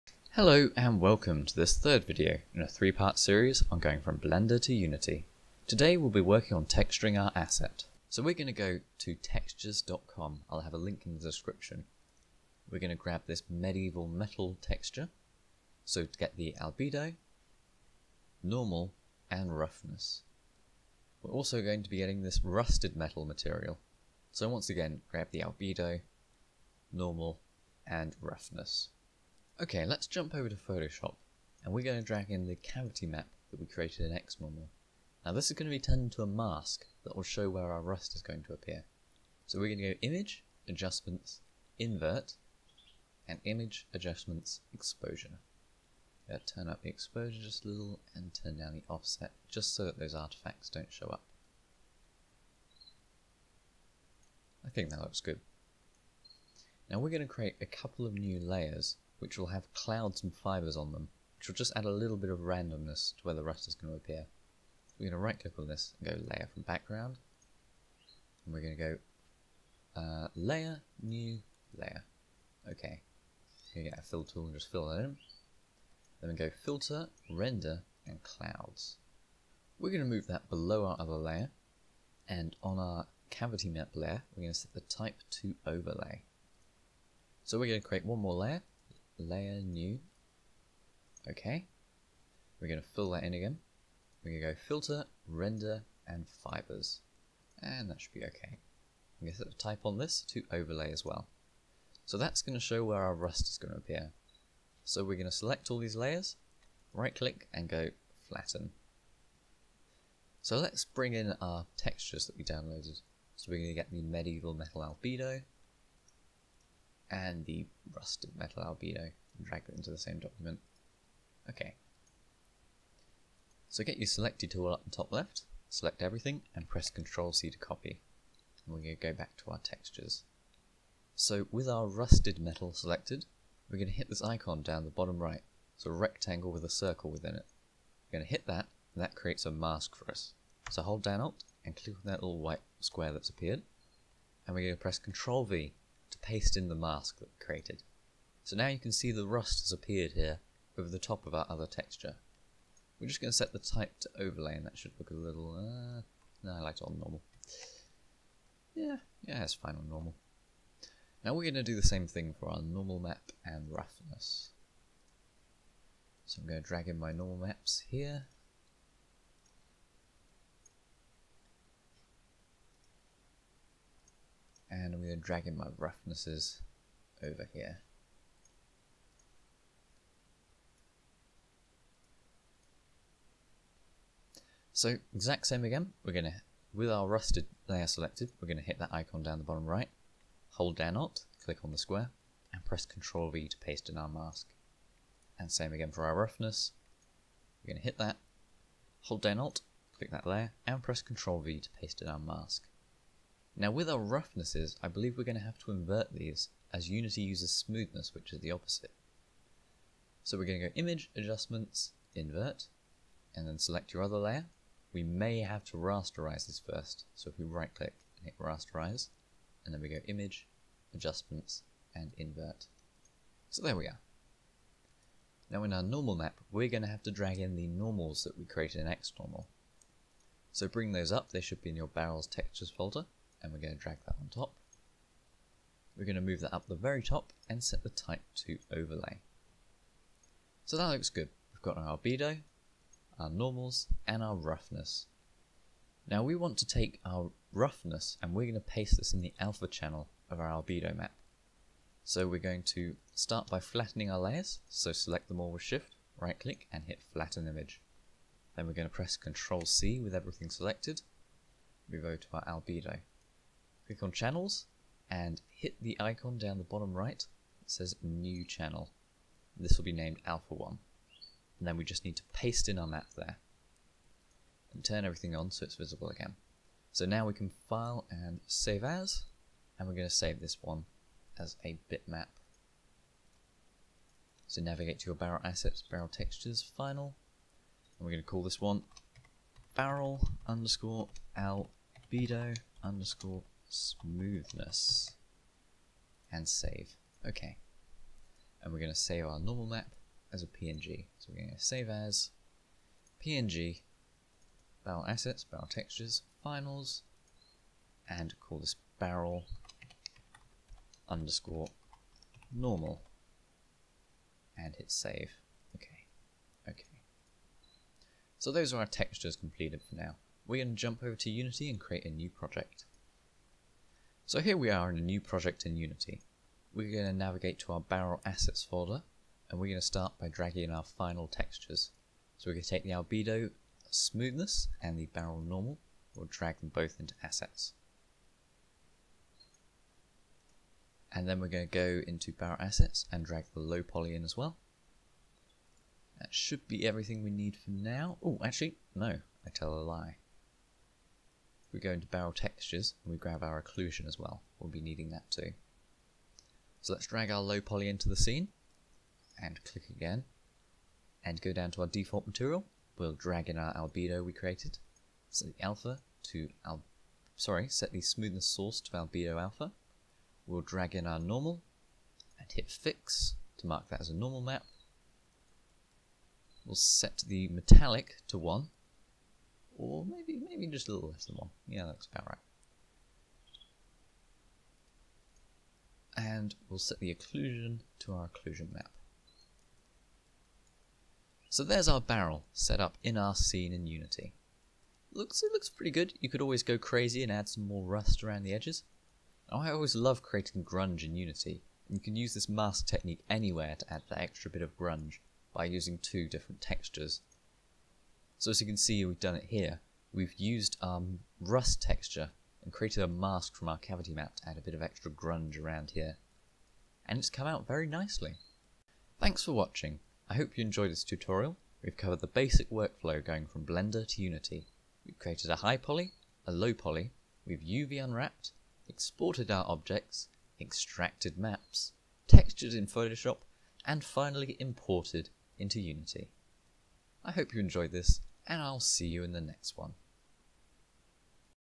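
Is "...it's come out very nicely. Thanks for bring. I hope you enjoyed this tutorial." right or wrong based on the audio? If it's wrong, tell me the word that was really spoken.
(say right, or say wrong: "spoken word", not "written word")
wrong: "watching", not "bring".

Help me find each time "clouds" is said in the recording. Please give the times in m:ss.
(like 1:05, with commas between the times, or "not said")
0:59, 1:18.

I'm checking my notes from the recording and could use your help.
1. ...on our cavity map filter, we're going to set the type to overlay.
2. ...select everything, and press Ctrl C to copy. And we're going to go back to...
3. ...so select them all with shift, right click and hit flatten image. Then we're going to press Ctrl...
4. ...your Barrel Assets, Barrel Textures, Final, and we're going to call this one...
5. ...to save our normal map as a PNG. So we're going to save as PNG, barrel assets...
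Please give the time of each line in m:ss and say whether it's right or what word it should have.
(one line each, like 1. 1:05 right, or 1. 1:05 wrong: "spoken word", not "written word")
1. 1:22 wrong: "layer", not "filter"
2. 2:05 right
3. 4:14 right
4. 4:45 right
5. 4:58 right.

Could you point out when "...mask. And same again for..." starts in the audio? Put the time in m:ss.
3:14.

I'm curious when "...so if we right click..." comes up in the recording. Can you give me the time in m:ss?
3:37.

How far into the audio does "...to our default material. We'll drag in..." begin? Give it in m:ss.
6:01.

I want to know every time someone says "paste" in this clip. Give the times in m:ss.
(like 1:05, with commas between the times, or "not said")
2:26, 3:13, 3:21, 4:08, 4:32.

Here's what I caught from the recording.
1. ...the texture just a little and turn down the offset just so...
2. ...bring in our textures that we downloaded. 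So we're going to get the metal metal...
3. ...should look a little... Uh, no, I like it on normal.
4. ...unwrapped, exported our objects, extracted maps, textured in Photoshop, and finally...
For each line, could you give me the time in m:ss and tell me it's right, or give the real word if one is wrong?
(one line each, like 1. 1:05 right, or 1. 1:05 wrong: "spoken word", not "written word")
1. 0:46 wrong: "exposure", not "texture"
2. 1:50 wrong: "medieval", not "metal"
3. 2:34 right
4. 7:08 right.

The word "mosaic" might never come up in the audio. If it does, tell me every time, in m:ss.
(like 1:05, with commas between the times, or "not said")
not said.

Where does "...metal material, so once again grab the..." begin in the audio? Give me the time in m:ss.
0:22.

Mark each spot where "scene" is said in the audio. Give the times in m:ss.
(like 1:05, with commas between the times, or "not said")
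5:58, 6:33.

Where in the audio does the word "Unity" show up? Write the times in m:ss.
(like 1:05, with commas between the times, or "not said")
0:04, 3:26, 5:21, 5:25, 6:33, 6:41, 7:04, 7:15.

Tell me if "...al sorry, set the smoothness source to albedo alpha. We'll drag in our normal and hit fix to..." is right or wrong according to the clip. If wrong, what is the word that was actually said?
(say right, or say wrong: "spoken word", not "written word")
right.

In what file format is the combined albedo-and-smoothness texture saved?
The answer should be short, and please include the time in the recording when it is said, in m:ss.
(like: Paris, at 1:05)
Bitmap, at 4:41.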